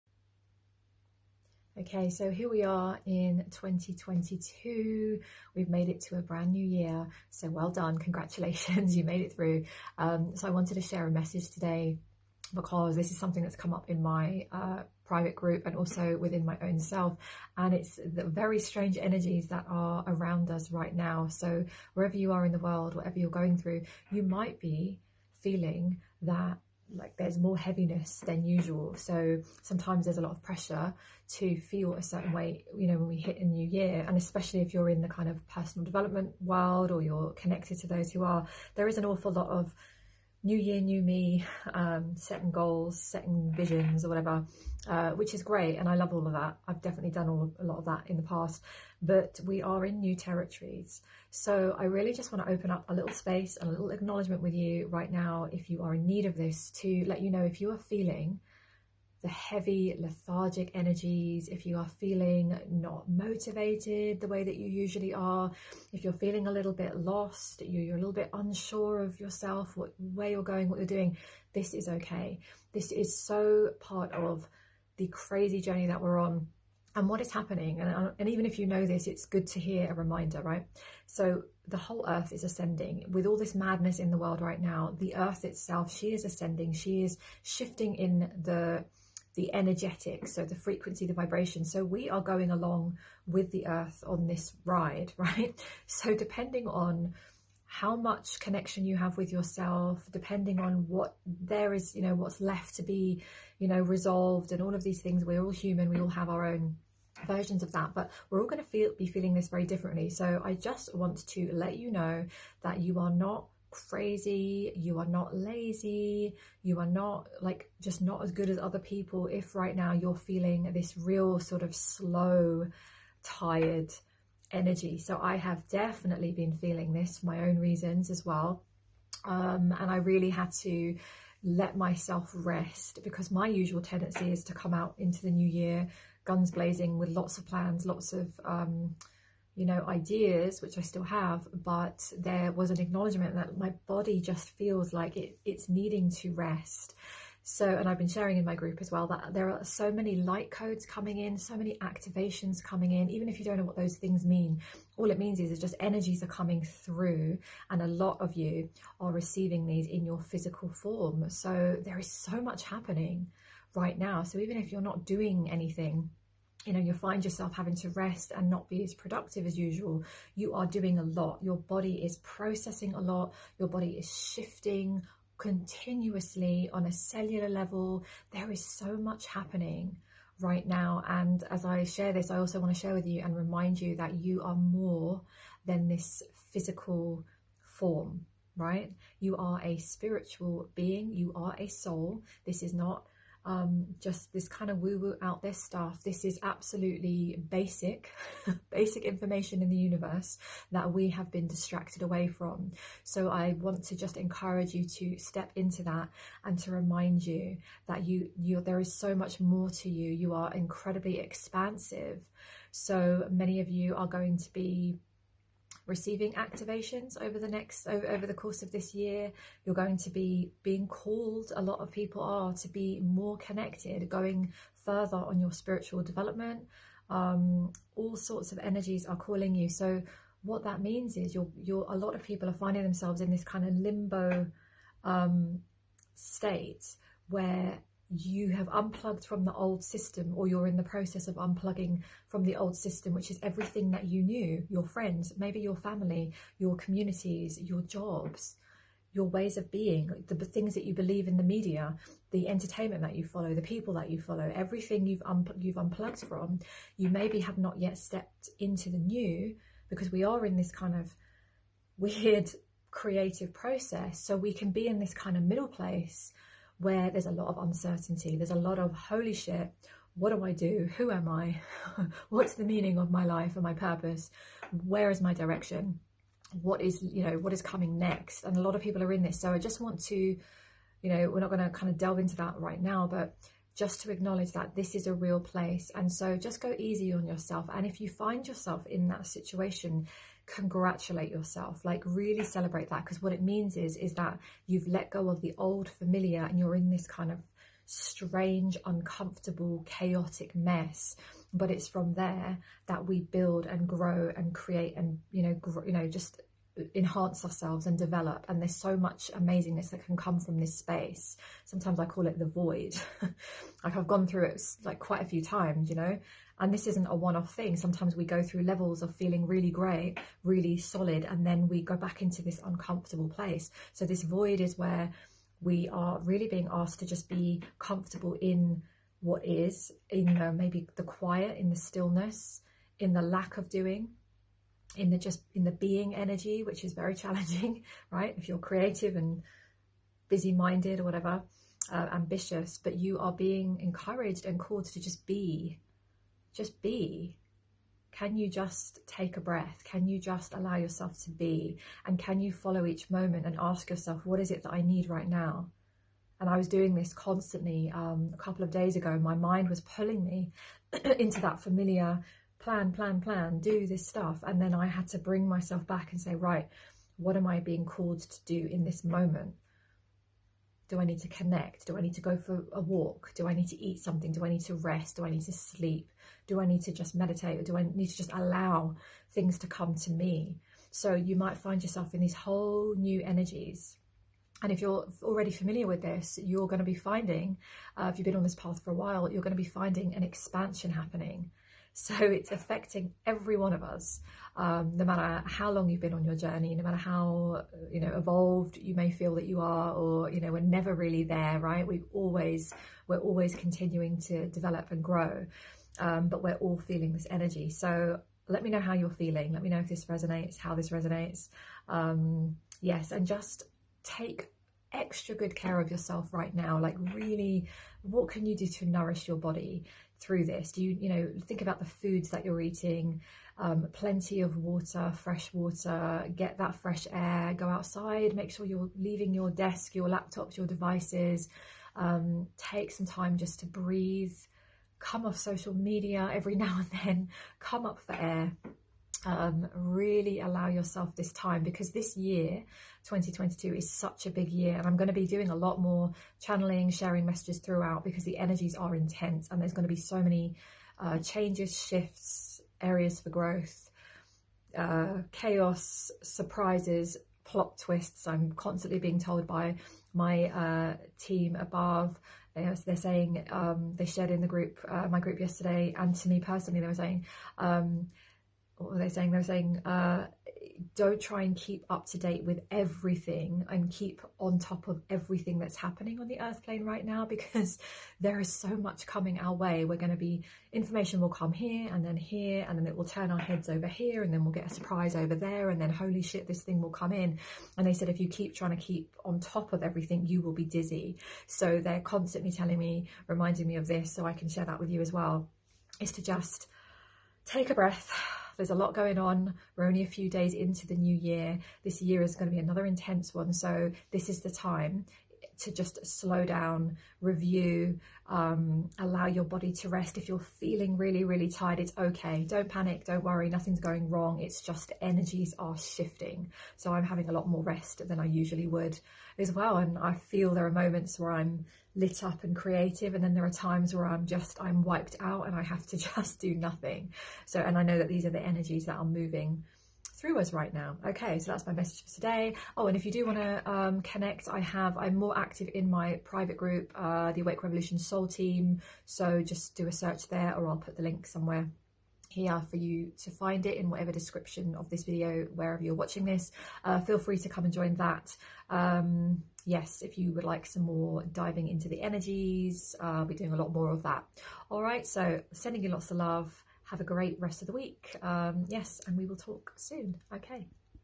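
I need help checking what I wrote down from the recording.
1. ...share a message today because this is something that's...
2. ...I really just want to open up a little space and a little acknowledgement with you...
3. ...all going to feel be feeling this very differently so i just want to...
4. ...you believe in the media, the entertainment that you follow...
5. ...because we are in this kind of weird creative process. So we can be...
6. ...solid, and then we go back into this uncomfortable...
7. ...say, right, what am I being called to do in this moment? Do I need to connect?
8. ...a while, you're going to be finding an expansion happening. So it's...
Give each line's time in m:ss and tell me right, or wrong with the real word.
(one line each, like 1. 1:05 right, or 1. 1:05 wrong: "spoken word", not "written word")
1. 0:10 right
2. 0:51 right
3. 1:48 right
4. 4:10 right
5. 4:19 right
6. 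5:20 right
7. 6:06 right
8. 6:28 right.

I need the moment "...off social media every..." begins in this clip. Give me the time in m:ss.
7:15.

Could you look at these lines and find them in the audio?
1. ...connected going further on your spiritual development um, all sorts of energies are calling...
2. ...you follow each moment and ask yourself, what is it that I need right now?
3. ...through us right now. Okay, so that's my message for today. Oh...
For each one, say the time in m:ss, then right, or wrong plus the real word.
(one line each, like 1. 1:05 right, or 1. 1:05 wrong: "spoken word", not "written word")
1. 3:43 right
2. 5:52 right
3. 8:50 right.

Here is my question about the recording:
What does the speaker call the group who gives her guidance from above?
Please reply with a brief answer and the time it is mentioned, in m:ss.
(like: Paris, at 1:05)
team above, at 7:41.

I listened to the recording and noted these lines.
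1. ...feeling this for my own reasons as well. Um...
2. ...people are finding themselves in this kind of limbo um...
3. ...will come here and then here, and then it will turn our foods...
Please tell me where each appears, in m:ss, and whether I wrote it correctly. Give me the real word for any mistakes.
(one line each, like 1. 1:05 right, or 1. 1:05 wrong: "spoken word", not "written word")
1. 2:06 right
2. 3:52 right
3. 8:01 wrong: "heads", not "foods".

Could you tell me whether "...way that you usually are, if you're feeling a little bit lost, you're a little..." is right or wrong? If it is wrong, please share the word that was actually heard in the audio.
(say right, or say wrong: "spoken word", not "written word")
right.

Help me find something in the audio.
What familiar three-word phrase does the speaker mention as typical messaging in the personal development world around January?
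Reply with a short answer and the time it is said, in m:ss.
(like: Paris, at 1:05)
new year new me, at 0:40.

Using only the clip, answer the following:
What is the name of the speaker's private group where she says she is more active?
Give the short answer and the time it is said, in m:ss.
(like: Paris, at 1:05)
Awake Revolution Soul Team, at 8:57.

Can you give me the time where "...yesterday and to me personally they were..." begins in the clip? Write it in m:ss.
7:45.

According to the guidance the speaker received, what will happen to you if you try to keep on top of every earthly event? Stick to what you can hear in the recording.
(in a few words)
you will be dizzy.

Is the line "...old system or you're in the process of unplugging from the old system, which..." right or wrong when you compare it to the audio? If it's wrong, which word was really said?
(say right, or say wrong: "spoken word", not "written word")
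right.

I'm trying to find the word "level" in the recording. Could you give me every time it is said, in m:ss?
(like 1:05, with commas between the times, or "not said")
2:57, 5:18.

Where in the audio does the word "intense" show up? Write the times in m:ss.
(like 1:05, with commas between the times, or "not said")
7:28, 8:22.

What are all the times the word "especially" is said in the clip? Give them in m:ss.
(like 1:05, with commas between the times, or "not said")
0:34.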